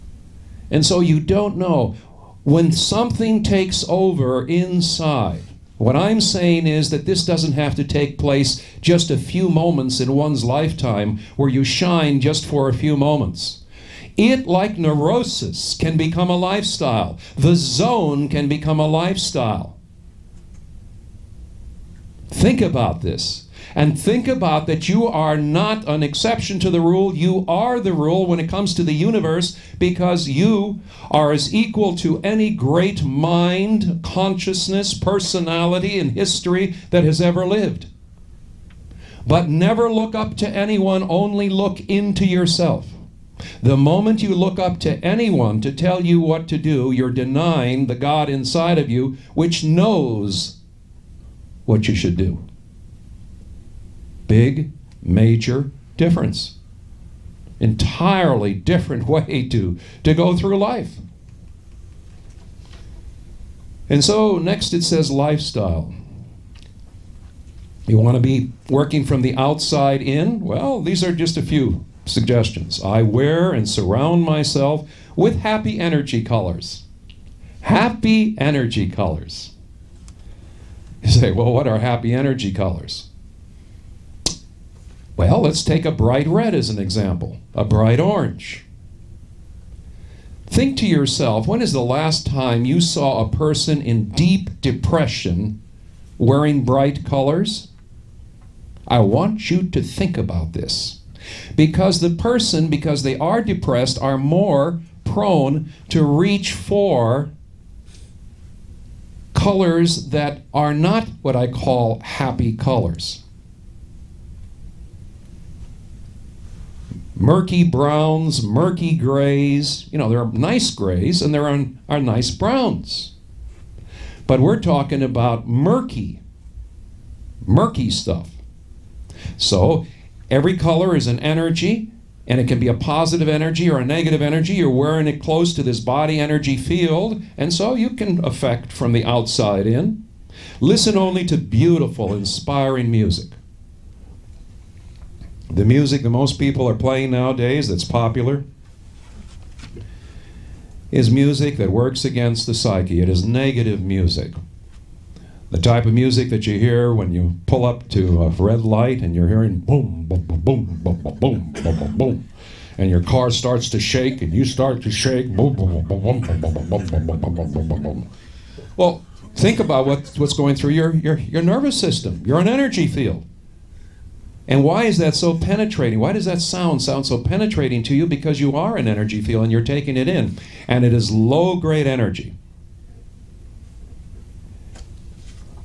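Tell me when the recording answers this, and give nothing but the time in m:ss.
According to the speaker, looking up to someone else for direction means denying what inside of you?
0:47.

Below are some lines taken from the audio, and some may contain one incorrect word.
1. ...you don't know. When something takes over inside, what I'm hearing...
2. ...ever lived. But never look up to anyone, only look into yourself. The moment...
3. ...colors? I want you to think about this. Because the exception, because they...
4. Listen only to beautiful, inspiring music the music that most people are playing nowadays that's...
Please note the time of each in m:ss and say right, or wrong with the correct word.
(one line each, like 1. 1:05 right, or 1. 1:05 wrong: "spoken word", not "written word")
1. 0:01 wrong: "saying", not "hearing"
2. 0:37 right
3. 1:37 wrong: "person", not "exception"
4. 2:20 right.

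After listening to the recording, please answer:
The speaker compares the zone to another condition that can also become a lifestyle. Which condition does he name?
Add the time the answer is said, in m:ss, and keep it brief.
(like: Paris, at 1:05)
Neurosis, at 0:14.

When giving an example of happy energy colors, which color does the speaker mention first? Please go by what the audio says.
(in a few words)
Bright red.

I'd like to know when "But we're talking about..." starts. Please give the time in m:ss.
2:04.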